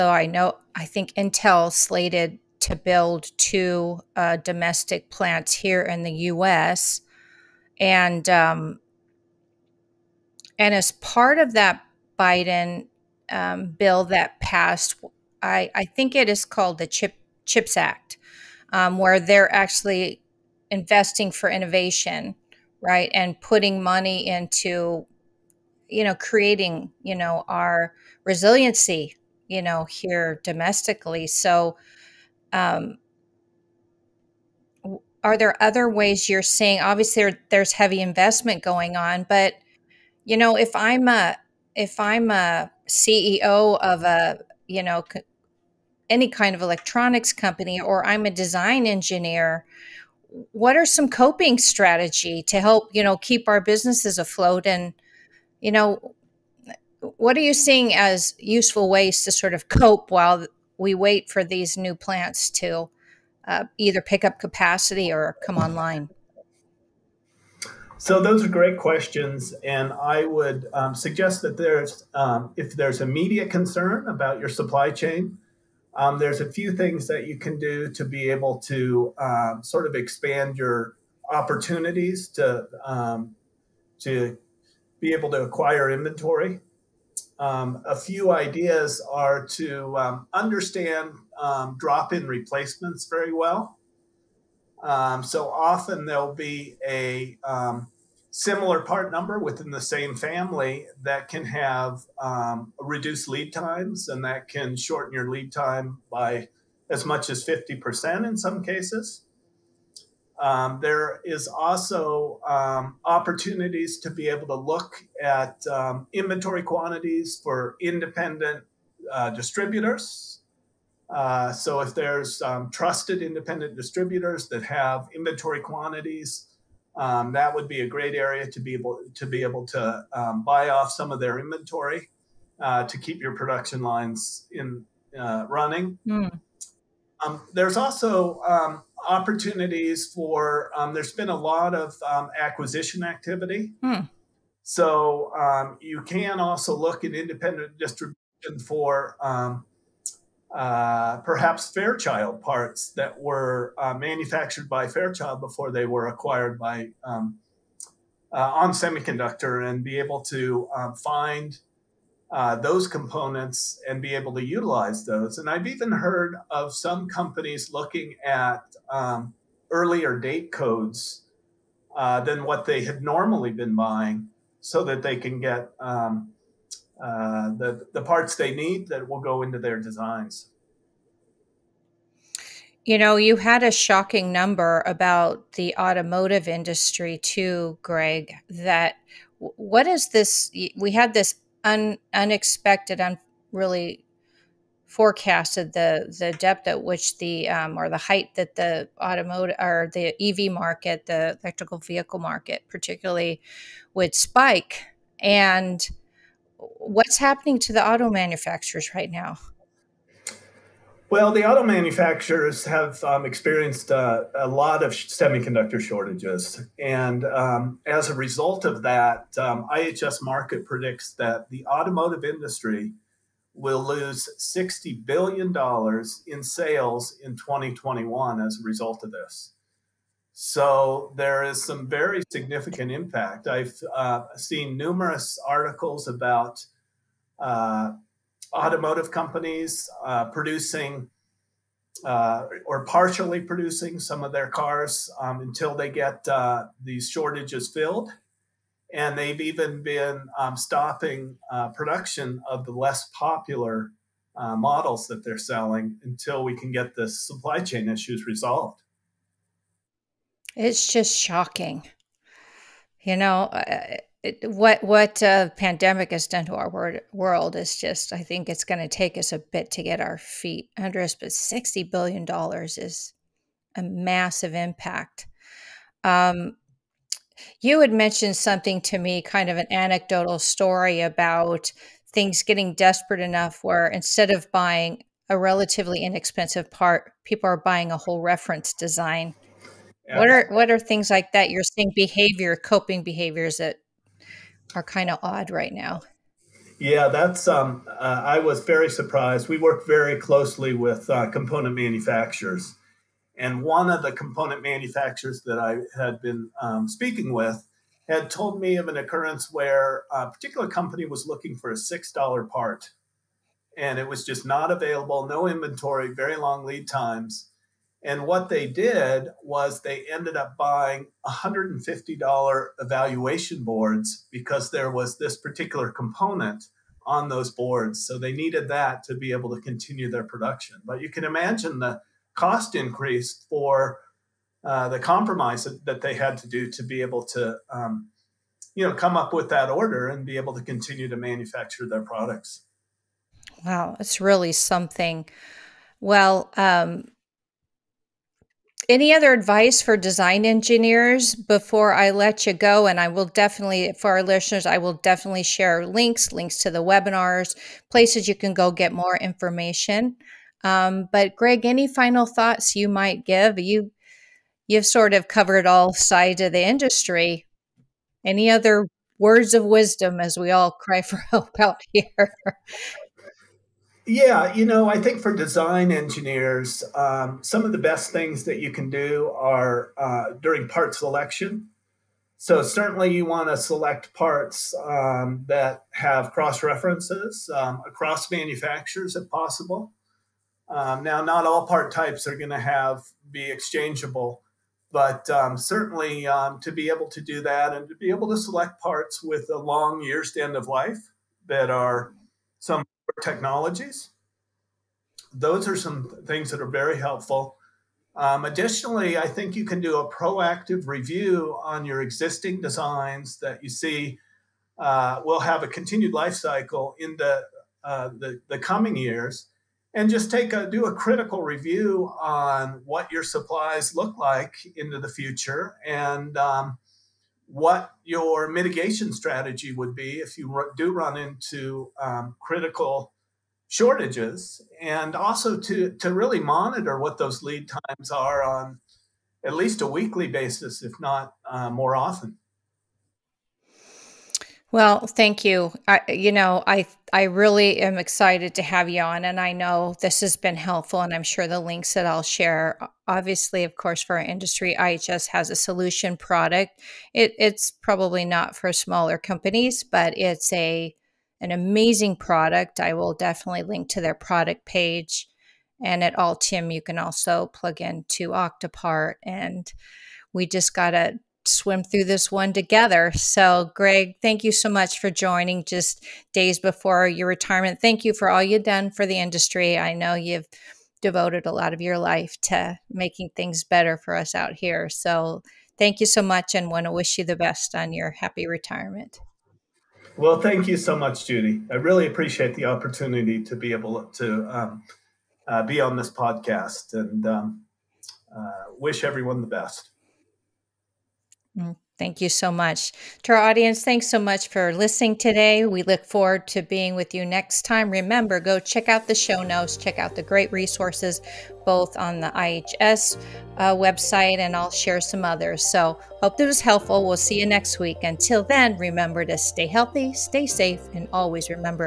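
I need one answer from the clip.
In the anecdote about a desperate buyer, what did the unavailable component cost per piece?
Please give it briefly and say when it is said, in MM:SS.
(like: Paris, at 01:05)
$6, at 05:11.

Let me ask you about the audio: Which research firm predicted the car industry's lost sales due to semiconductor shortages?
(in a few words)
IHS Markit.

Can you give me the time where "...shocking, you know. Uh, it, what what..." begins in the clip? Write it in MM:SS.
04:21.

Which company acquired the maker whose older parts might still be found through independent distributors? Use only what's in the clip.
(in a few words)
ON Semiconductor.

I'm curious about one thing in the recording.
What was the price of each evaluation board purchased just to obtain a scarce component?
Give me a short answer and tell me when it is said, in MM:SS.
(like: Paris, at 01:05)
$150, at 05:21.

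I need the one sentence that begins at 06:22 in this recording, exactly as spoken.
So certainly, you want to select parts um, that have cross references um, across manufacturers, if possible.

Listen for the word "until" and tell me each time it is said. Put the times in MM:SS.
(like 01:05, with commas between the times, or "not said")
04:05, 04:16, 08:38.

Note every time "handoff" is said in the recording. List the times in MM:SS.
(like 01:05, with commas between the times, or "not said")
not said.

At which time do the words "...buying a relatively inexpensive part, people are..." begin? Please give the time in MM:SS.
04:44.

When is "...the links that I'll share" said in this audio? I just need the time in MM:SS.
07:31.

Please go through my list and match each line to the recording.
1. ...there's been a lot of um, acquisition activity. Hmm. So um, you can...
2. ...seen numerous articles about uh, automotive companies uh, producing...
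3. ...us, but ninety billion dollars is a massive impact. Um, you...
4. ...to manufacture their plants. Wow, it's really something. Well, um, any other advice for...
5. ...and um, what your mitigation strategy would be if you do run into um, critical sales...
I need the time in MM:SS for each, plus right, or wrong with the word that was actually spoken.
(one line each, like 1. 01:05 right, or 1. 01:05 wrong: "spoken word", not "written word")
1. 02:20 right
2. 03:54 right
3. 04:31 wrong: "sixty", not "ninety"
4. 05:41 wrong: "products", not "plants"
5. 07:05 wrong: "shortages", not "sales".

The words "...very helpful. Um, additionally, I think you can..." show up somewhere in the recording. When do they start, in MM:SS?
06:46.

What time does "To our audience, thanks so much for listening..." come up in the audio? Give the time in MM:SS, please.
08:23.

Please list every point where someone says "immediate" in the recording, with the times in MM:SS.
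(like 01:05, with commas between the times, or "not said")
01:12.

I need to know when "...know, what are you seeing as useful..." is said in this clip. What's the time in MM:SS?
00:55.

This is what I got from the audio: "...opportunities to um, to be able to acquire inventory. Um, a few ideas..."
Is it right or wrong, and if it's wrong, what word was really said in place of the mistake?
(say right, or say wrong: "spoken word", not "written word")
right.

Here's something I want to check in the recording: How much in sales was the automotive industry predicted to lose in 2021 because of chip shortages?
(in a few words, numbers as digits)
$60 billion.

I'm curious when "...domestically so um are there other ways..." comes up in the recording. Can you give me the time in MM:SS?
00:30.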